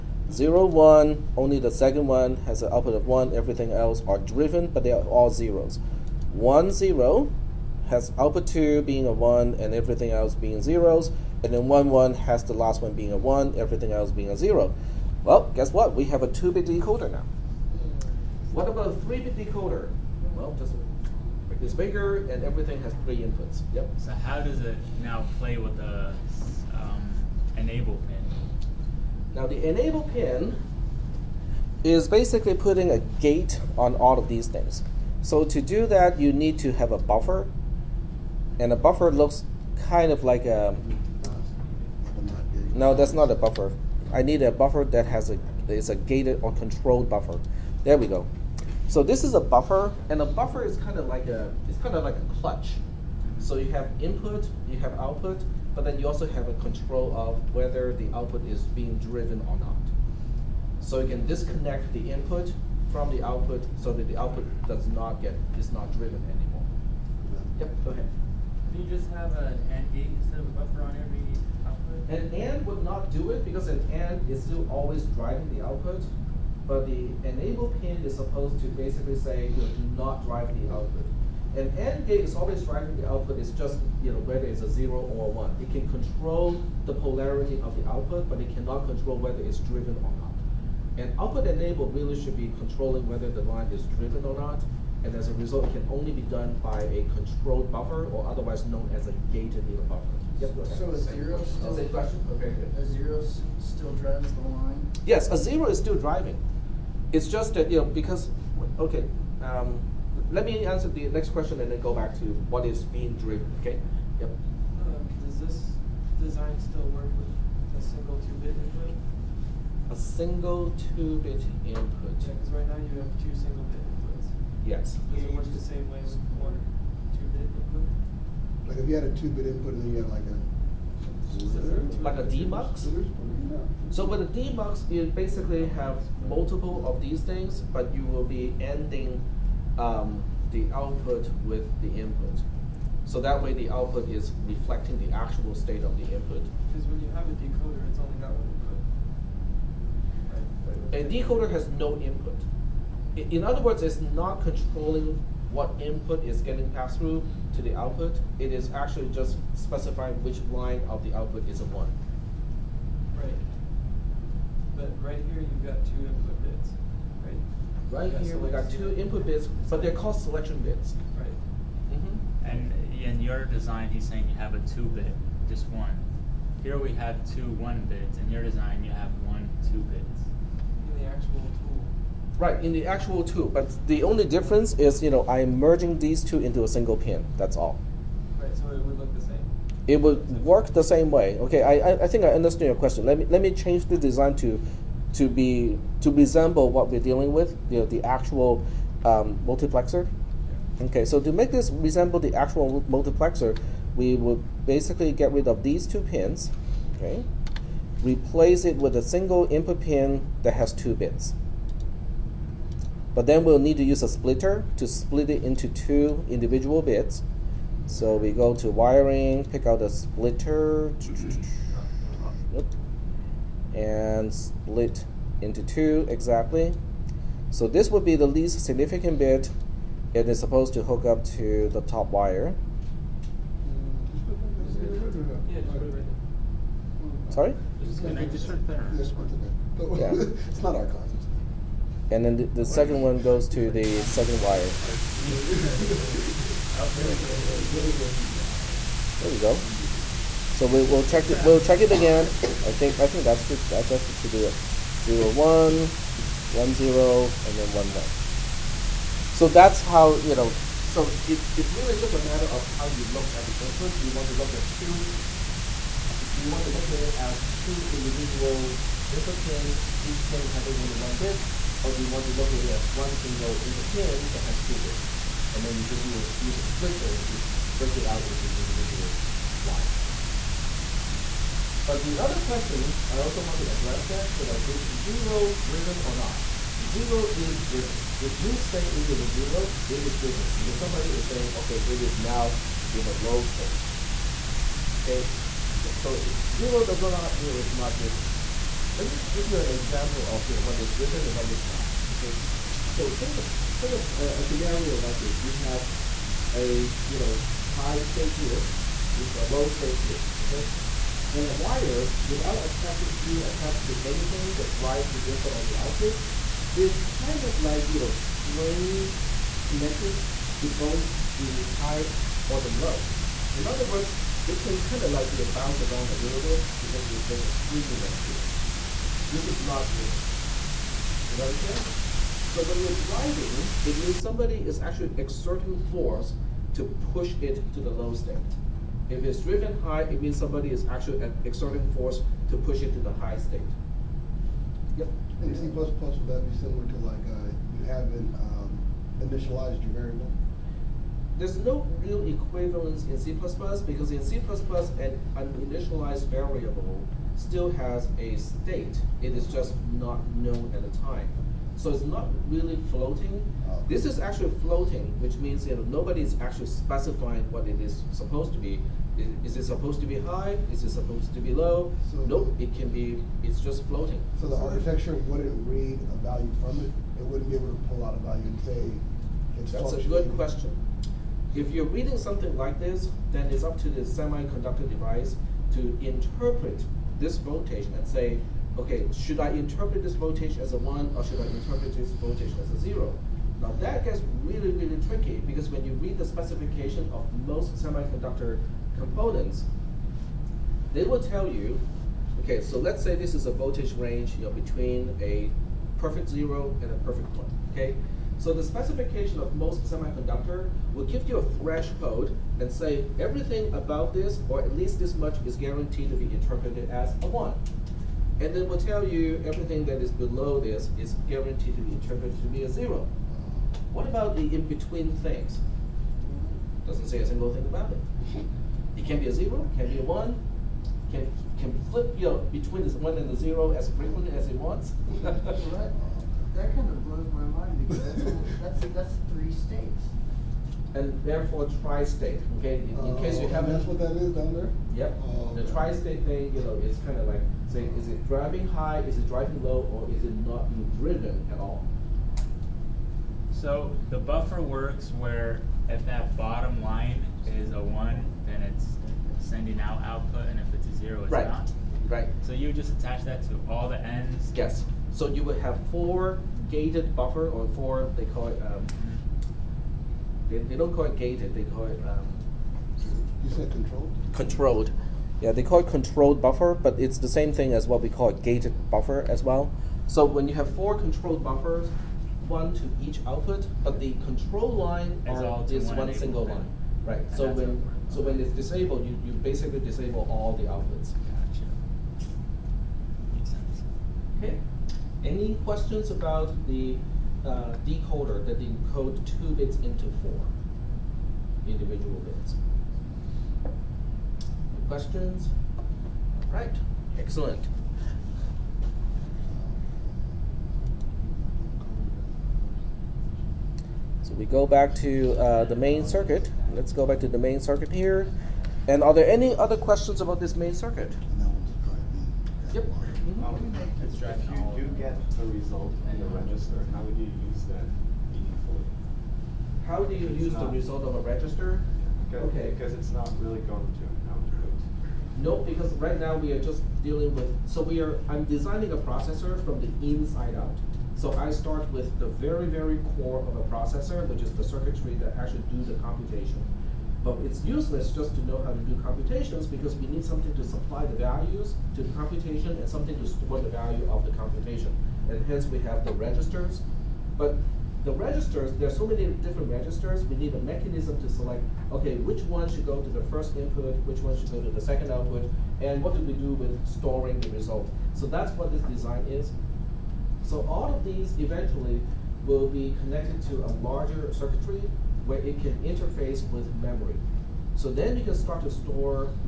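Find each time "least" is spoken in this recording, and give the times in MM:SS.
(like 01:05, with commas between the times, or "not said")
03:48, 06:54.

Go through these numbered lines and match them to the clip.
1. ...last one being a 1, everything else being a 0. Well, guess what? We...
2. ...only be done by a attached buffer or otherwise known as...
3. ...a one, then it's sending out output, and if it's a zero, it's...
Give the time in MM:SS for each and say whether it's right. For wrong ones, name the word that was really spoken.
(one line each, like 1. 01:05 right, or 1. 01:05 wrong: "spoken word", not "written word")
1. 00:12 right
2. 01:35 wrong: "controlled", not "attached"
3. 07:37 right.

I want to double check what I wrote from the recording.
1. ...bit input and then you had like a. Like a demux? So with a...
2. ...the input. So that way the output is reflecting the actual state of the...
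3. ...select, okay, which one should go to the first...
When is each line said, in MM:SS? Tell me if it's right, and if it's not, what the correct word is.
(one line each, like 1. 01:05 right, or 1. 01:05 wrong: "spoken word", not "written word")
1. 02:09 right
2. 02:21 right
3. 09:21 right.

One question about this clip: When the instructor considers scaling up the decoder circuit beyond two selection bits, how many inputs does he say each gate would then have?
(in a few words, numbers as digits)
3.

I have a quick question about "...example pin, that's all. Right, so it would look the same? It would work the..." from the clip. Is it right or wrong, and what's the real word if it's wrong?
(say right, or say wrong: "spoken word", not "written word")
wrong: "single", not "example".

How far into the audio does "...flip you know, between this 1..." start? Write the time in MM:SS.
07:11.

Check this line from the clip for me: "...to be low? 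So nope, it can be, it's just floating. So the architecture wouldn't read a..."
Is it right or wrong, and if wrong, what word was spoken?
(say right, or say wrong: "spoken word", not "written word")
right.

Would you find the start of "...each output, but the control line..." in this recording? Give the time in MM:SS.
08:03.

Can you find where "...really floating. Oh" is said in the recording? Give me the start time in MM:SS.
06:02.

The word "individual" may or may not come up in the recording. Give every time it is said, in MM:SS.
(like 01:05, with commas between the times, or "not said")
03:36, 04:27, 04:38, 08:21.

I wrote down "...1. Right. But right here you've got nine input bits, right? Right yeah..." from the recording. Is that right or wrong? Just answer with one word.
wrong.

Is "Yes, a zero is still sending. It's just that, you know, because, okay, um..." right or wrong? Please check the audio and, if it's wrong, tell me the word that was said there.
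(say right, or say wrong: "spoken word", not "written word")
wrong: "driving", not "sending".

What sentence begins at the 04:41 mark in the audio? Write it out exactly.
But the other question I also want to address that, you know, is zero driven or not?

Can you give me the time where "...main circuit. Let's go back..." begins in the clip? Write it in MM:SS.
08:35.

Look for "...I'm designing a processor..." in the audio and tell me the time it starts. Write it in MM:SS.
08:58.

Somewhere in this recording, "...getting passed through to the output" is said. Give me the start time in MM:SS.
02:36.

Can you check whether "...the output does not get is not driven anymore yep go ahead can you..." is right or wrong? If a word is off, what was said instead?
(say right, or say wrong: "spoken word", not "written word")
right.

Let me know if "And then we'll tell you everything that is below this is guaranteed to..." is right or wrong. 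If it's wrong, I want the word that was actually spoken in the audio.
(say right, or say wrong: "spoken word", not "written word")
right.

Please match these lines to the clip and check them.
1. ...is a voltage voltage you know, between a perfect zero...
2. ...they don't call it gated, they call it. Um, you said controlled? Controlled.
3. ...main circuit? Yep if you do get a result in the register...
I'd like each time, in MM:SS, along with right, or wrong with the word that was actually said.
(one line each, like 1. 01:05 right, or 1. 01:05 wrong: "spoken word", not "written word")
1. 06:43 wrong: "range", not "voltage"
2. 07:50 right
3. 08:40 right.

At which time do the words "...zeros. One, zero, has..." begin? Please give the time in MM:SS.
00:05.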